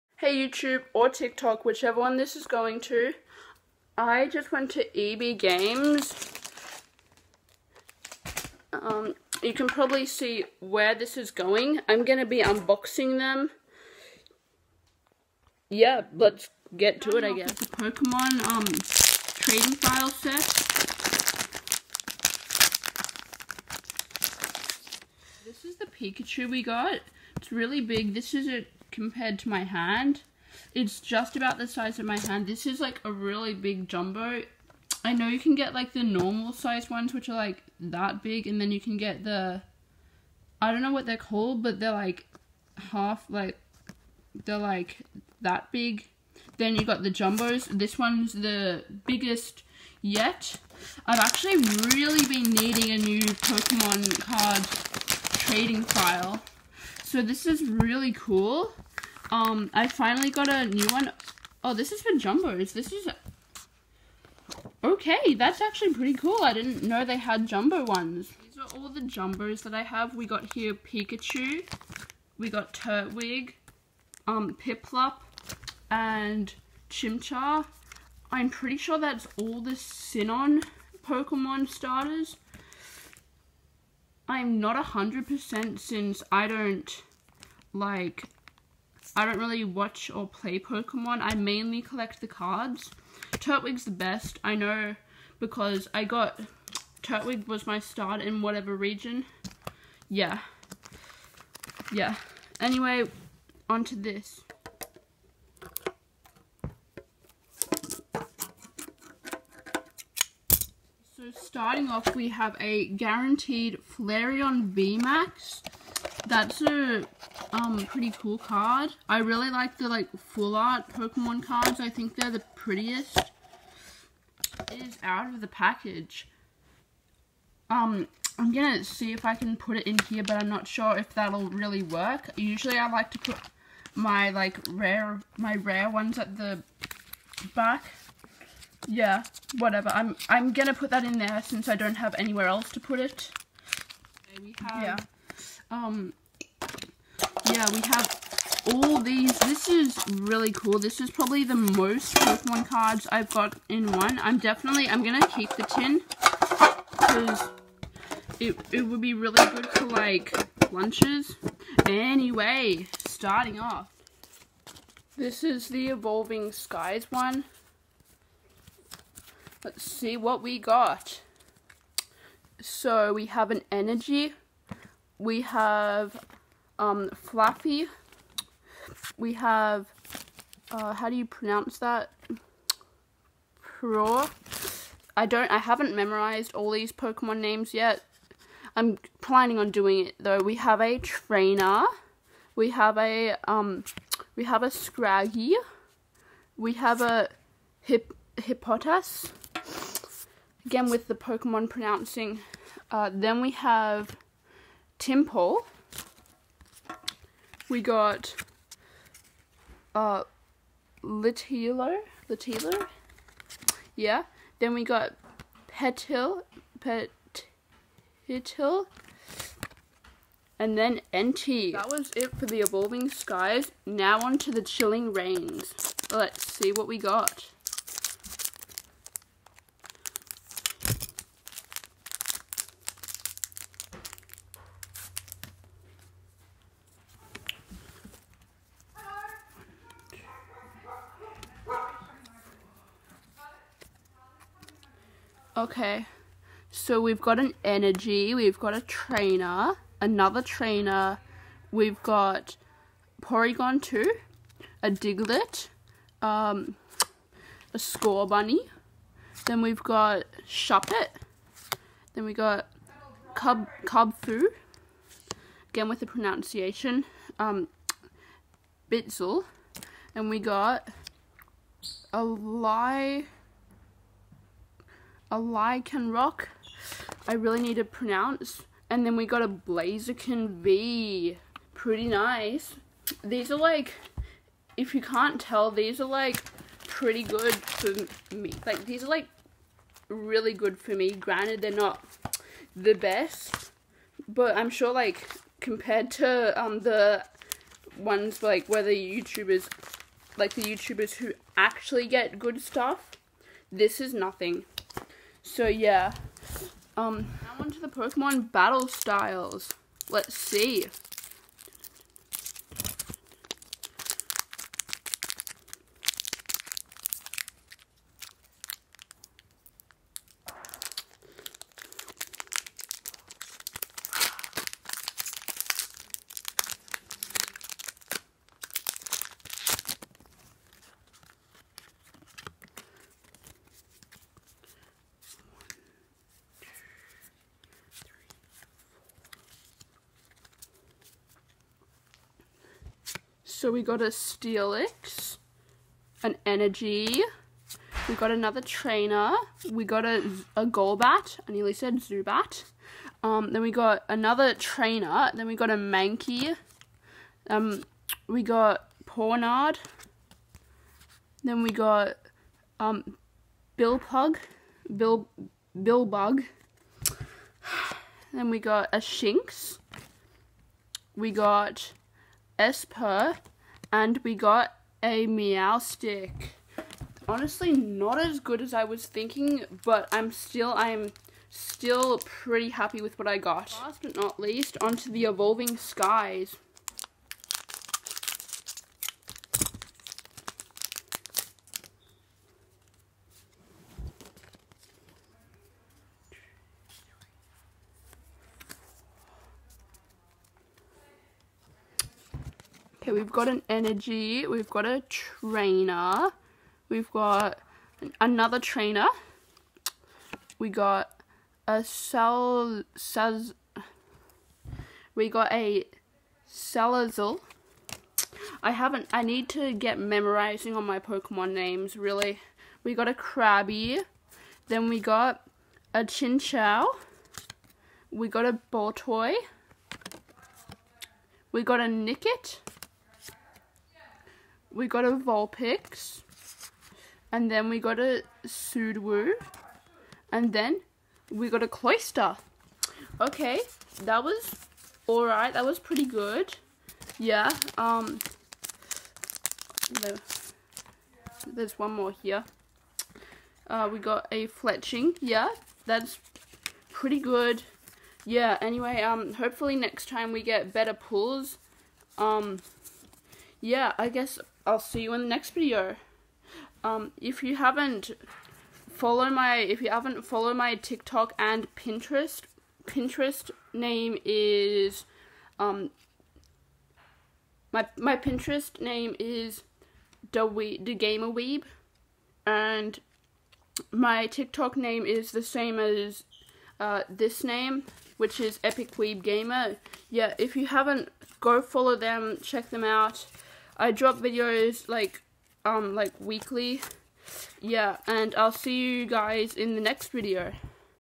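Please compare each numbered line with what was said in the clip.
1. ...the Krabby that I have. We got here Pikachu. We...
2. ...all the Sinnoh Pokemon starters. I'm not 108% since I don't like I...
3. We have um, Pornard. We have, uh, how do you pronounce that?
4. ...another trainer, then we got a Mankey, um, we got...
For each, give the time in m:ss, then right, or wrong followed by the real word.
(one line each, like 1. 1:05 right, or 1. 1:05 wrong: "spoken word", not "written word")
1. 1:08 wrong: "Jumbos", not "Krabby"
2. 1:19 wrong: "100", not "108"
3. 2:55 wrong: "Fluffy", not "Pornard"
4. 5:54 right.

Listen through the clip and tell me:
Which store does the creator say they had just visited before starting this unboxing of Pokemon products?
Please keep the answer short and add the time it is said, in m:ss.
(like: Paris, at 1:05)
EB Games, at 0:04.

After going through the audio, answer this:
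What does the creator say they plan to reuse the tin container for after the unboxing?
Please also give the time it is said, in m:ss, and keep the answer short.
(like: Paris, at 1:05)
lunches, at 2:40.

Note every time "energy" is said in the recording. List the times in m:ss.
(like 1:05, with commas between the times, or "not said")
2:53, 4:07, 5:46, 6:43.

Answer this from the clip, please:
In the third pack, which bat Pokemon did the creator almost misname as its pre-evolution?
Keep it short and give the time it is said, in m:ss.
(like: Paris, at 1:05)
Golbat, at 5:50.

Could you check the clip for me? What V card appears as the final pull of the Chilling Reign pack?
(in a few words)
Blaziken V.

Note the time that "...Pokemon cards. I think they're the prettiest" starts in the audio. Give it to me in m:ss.
2:00.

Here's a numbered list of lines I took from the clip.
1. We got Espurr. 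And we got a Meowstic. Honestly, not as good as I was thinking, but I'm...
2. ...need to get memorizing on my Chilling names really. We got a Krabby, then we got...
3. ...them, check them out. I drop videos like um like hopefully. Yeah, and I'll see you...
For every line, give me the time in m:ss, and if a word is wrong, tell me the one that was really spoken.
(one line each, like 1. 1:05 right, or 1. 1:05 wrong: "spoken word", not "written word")
1. 6:11 right
2. 6:59 wrong: "Pokemon", not "Chilling"
3. 8:11 wrong: "weekly", not "hopefully".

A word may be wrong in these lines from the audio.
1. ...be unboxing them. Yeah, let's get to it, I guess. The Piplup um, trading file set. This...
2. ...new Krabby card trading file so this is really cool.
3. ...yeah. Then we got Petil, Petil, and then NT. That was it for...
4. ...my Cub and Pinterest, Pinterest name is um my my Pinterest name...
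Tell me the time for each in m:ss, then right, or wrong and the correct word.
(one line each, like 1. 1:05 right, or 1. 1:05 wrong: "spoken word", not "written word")
1. 0:12 wrong: "Pokemon", not "Piplup"
2. 0:52 wrong: "Pokemon", not "Krabby"
3. 3:33 right
4. 7:50 wrong: "TikTok", not "Cub".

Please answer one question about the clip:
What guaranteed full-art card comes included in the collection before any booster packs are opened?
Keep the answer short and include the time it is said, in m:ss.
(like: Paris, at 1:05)
Flareon VMAX, at 1:53.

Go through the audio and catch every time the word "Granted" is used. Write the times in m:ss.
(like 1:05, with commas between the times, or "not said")
4:51.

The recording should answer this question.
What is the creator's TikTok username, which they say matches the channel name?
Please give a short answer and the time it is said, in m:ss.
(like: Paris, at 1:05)
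Epic Weeb Gamer, at 8:08.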